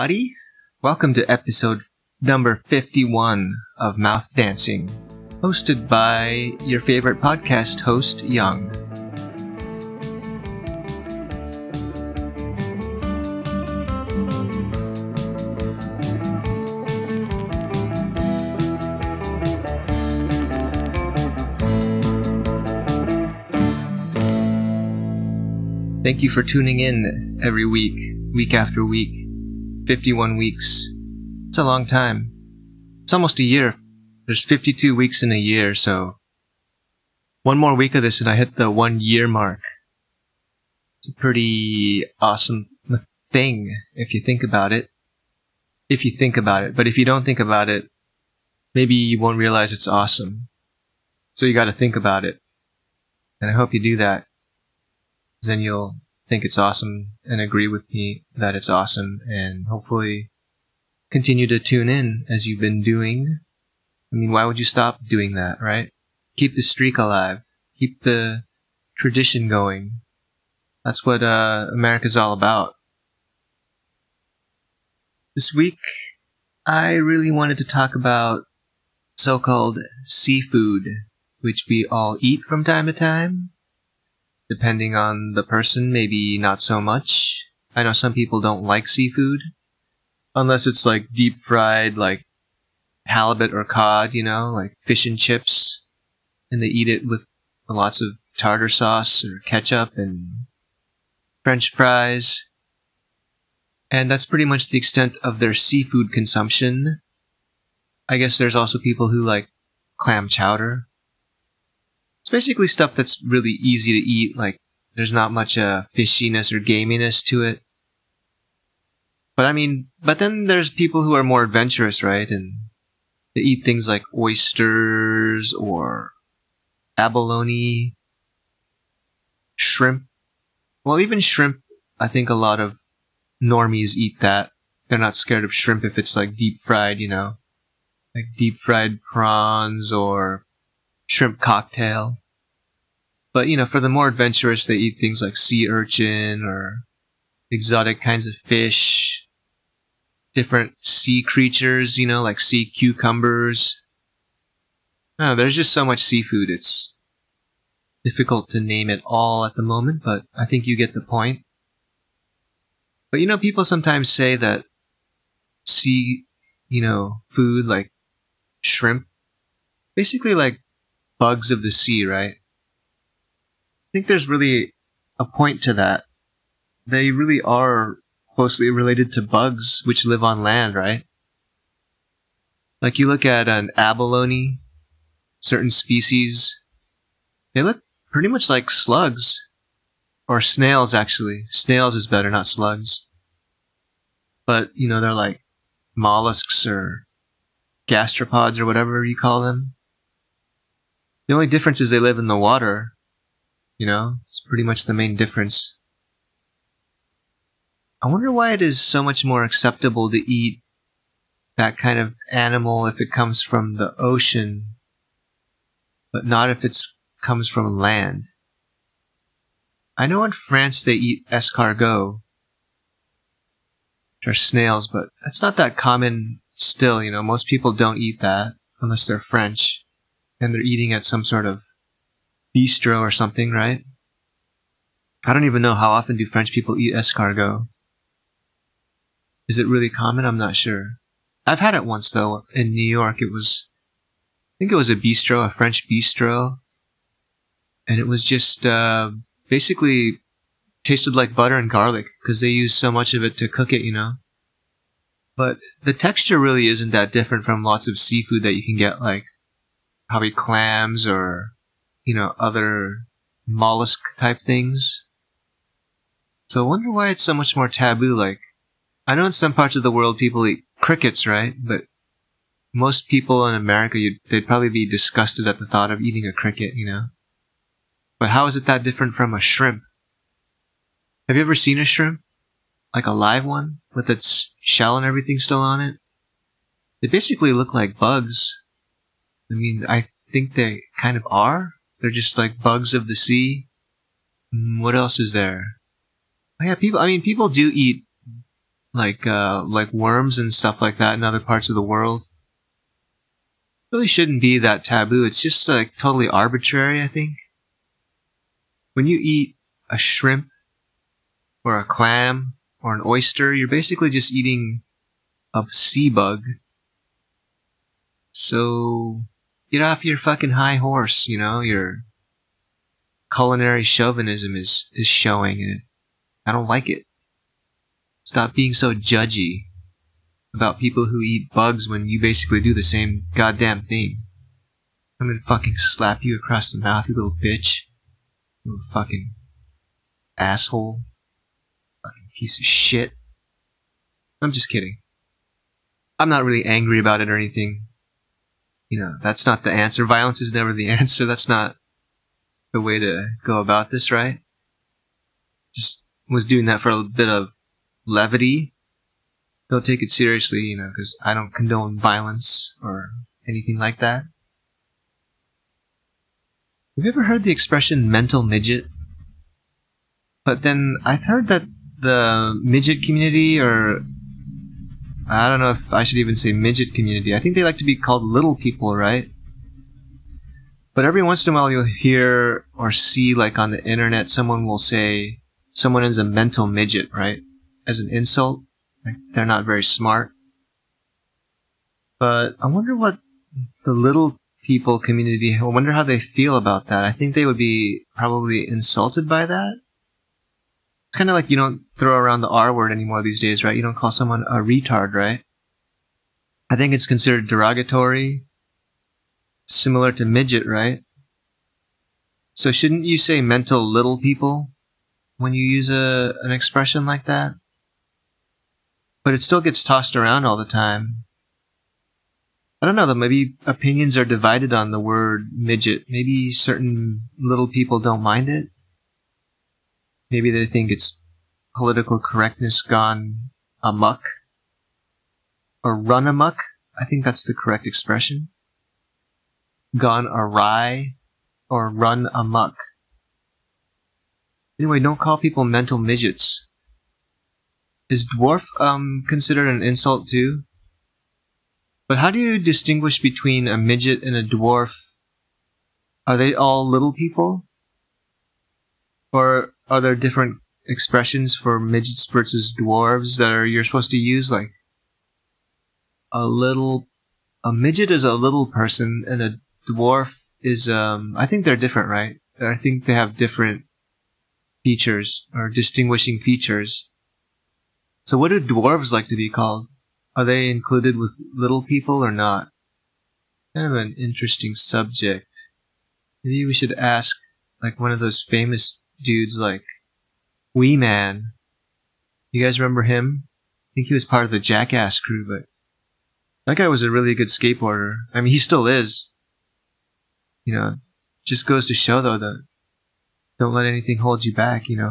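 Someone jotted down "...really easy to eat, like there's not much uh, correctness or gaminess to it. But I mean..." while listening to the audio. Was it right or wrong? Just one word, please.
wrong.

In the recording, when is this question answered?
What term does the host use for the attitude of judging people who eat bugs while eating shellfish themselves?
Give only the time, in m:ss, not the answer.
5:23.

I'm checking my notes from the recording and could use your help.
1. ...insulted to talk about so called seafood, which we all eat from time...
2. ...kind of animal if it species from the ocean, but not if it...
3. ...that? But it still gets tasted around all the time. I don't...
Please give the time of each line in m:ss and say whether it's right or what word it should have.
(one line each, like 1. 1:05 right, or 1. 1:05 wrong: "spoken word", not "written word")
1. 1:17 wrong: "wanted", not "insulted"
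2. 3:31 wrong: "comes", not "species"
3. 6:57 wrong: "tossed", not "tasted".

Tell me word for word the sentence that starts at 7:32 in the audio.
But how do you distinguish between a midget and a dwarf?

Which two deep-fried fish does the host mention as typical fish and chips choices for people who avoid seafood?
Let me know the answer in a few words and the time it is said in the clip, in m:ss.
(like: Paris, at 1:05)
halibut or cod, at 1:33.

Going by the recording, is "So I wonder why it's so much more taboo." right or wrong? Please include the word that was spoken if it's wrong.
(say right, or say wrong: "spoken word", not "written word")
right.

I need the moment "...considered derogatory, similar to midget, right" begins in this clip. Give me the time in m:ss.
6:47.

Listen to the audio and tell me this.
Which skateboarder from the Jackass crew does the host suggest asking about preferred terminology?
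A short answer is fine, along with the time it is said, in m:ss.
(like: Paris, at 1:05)
Wee Man, at 8:10.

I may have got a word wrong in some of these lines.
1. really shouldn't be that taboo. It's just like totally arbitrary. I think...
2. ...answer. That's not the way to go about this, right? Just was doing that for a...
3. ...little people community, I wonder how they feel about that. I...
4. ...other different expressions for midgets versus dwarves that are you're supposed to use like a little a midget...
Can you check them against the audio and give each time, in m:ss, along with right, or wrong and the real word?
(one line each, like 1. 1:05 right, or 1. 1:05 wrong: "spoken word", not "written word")
1. 5:03 right
2. 5:50 right
3. 6:33 right
4. 7:39 right.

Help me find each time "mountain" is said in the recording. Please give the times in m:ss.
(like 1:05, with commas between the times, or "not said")
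not said.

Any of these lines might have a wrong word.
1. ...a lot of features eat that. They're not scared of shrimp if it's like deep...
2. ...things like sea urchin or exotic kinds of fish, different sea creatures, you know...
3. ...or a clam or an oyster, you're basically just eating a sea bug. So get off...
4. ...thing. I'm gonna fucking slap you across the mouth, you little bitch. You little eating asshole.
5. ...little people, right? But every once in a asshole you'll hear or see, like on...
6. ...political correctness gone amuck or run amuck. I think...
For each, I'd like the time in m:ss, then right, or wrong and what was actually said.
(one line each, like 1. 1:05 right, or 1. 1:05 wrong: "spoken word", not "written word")
1. 2:12 wrong: "normies", not "features"
2. 2:24 right
3. 5:11 right
4. 5:33 wrong: "fucking", not "eating"
5. 6:18 wrong: "while", not "asshole"
6. 7:11 right.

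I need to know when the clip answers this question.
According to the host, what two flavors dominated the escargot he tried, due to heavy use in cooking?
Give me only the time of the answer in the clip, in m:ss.
4:11.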